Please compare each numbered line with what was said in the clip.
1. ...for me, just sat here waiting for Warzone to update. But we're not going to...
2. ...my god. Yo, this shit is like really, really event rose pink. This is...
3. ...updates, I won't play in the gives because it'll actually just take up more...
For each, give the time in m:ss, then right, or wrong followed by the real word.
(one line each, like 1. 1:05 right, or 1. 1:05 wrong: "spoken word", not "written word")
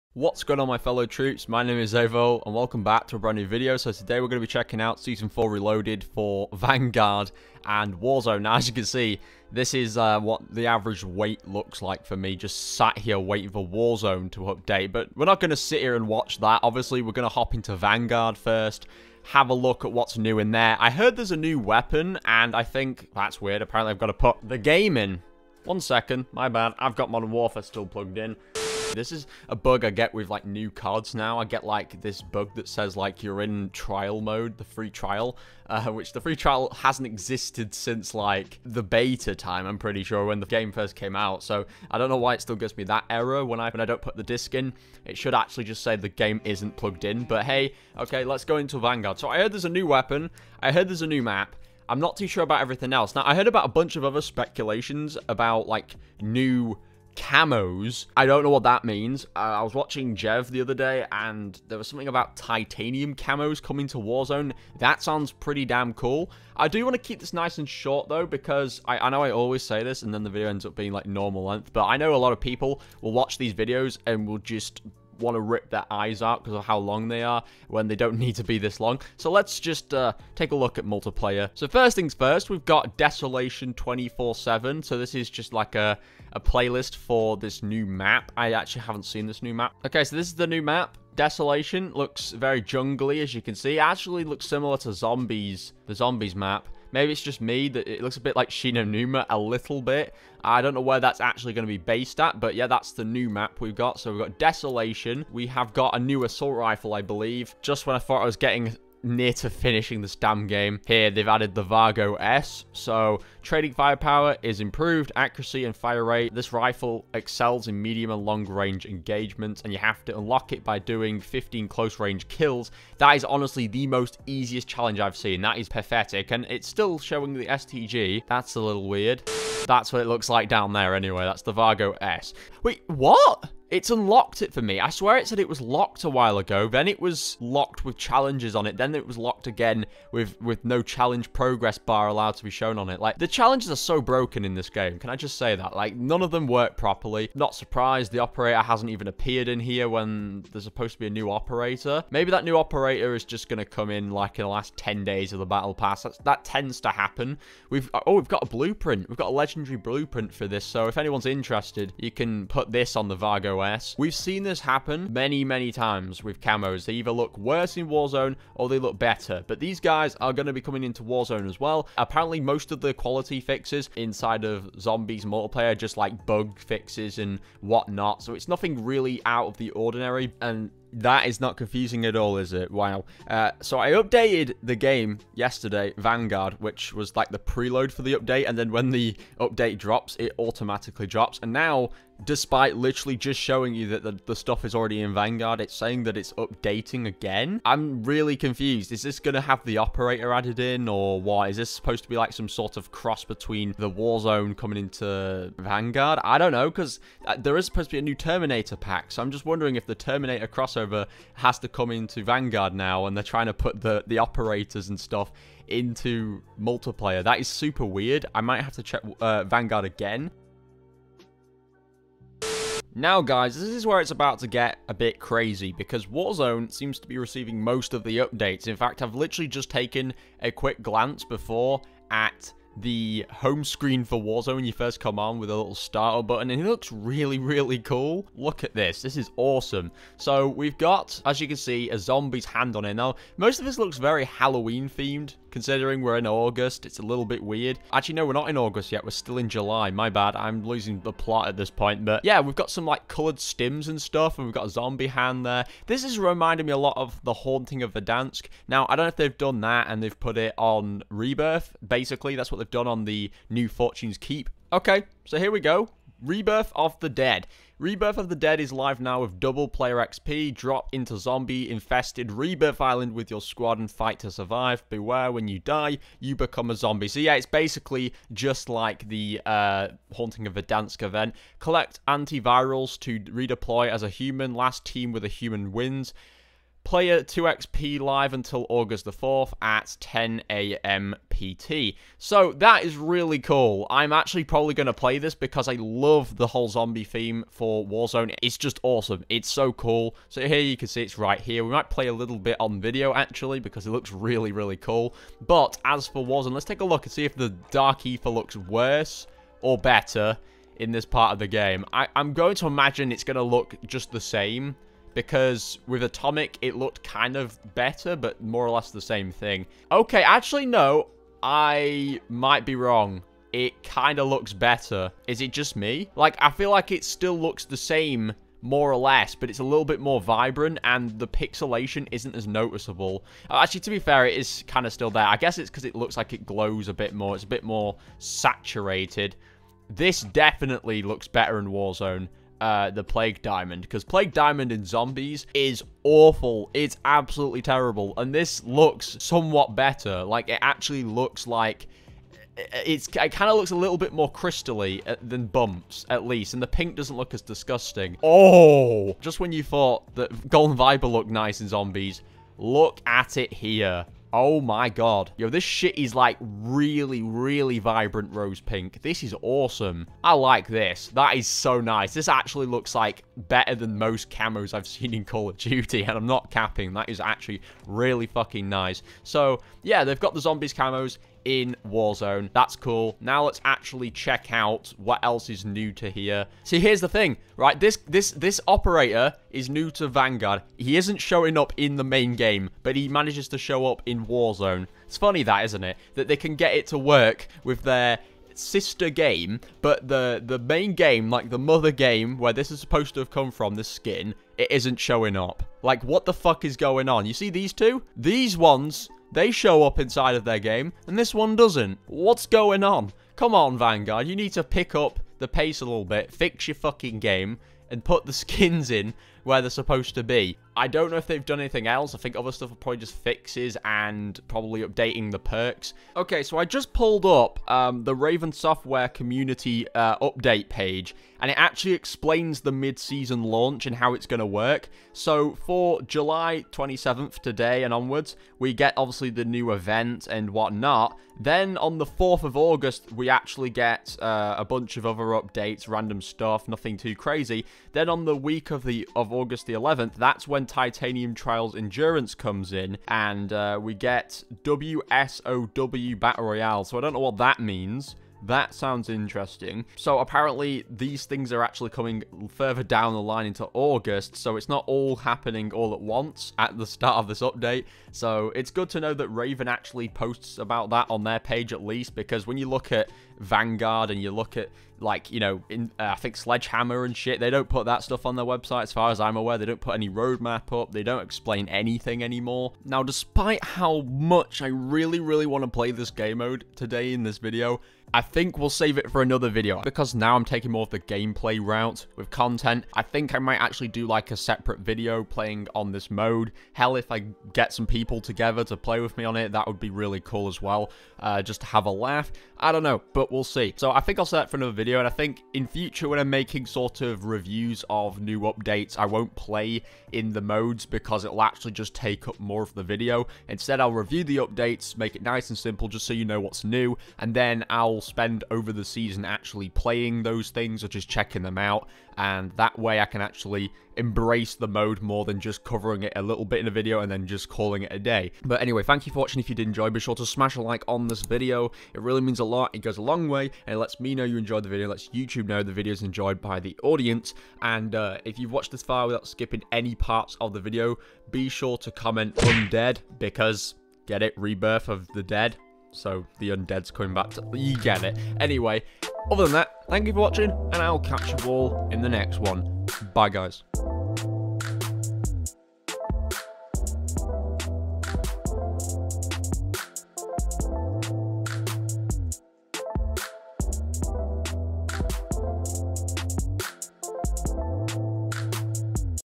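1. 0:12 right
2. 6:04 wrong: "vibrant", not "event"
3. 8:28 wrong: "modes", not "gives".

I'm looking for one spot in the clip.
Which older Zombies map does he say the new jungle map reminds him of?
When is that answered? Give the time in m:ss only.
1:38.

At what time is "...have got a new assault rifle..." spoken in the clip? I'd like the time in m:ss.
1:45.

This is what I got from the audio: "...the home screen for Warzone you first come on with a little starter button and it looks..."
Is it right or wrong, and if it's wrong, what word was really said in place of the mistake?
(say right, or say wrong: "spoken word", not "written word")
right.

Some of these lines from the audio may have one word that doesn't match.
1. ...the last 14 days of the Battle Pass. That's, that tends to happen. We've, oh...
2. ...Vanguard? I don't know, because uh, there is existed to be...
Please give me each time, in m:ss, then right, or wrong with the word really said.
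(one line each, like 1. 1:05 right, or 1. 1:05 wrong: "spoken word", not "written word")
1. 2:34 wrong: "10", not "14"
2. 3:25 wrong: "supposed", not "existed".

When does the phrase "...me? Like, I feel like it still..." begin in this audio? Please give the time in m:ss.
5:25.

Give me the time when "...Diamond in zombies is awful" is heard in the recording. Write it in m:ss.
5:44.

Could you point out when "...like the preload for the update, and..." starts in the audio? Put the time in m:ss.
3:07.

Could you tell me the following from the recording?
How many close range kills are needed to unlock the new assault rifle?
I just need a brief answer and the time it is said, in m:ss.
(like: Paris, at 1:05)
15, at 2:01.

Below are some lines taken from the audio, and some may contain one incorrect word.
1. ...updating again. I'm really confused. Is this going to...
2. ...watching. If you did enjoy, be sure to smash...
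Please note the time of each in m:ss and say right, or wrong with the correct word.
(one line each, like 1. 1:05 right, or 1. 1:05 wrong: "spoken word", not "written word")
1. 3:16 right
2. 8:49 right.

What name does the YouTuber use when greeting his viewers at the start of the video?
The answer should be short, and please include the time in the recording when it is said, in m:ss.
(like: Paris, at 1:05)
Xavvo, at 0:01.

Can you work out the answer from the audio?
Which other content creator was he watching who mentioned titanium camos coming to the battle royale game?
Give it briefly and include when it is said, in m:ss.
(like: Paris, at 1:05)
Jev, at 1:00.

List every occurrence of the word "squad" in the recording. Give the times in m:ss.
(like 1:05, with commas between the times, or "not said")
4:33.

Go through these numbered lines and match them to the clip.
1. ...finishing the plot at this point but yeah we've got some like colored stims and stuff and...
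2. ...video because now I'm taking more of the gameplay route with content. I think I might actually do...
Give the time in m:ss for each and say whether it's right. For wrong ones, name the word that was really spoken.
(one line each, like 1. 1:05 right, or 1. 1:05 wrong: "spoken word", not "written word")
1. 4:10 wrong: "losing", not "finishing"
2. 8:09 right.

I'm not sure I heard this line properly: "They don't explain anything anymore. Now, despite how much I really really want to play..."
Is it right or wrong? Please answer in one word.
right.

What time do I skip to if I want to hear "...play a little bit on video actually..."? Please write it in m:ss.
5:01.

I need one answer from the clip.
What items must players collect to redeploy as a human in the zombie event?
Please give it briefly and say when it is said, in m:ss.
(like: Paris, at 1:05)
antivirals, at 4:42.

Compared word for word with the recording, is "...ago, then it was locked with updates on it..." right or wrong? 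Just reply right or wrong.
wrong.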